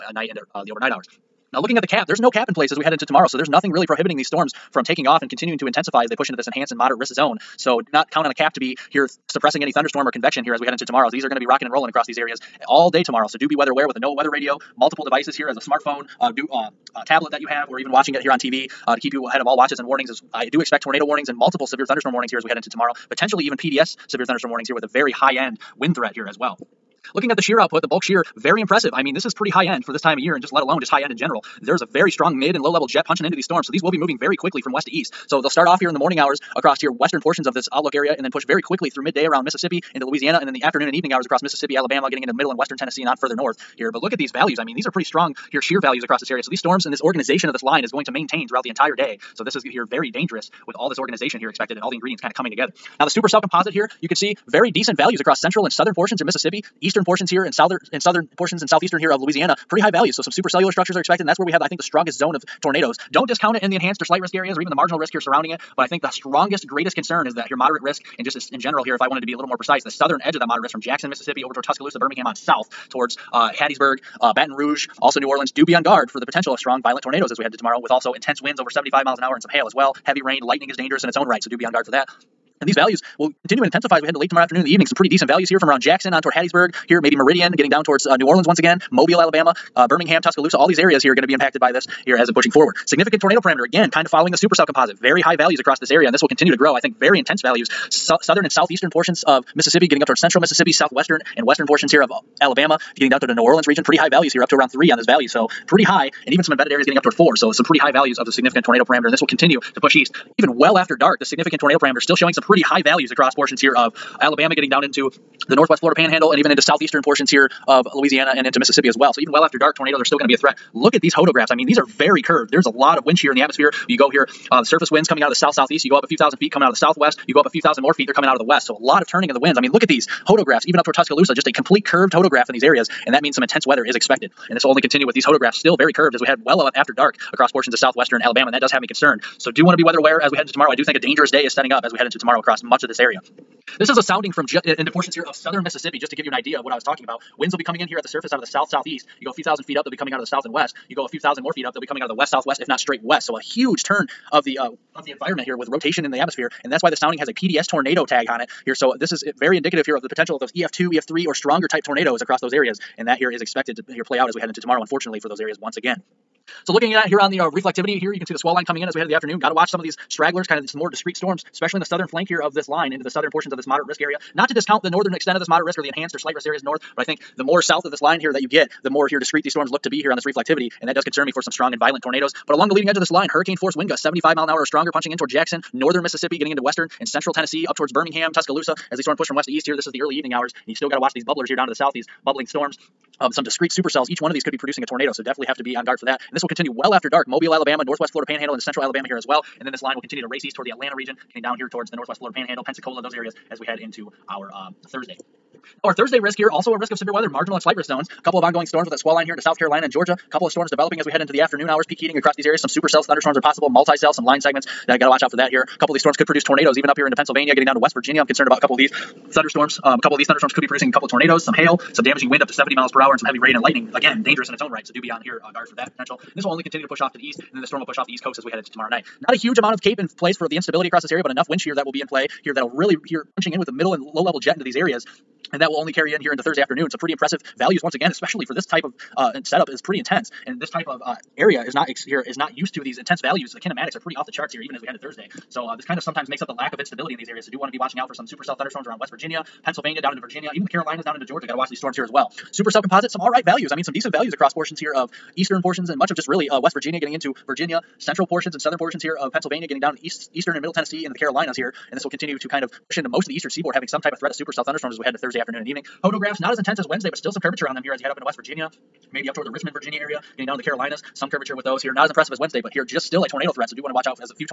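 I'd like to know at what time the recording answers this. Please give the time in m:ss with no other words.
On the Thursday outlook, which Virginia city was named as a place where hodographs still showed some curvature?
4:29.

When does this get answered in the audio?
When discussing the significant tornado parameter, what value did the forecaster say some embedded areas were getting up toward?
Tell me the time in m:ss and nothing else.
1:47.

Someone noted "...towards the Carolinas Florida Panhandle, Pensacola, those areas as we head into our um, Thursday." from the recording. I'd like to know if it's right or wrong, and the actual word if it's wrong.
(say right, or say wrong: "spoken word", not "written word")
wrong: "Northwest", not "Carolinas".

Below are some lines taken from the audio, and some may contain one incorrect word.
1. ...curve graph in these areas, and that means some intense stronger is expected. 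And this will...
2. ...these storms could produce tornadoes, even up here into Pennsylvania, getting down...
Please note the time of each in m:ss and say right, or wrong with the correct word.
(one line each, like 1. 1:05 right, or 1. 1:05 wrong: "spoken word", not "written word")
1. 2:11 wrong: "weather", not "stronger"
2. 3:35 right.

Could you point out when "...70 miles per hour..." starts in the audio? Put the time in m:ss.
3:42.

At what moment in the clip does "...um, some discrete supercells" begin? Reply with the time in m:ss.
3:13.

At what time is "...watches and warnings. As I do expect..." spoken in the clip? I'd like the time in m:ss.
0:19.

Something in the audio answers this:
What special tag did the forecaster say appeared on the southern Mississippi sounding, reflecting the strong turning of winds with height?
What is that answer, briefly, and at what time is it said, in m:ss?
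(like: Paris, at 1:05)
PDS tornado, at 2:37.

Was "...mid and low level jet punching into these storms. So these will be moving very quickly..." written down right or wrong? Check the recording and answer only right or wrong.
right.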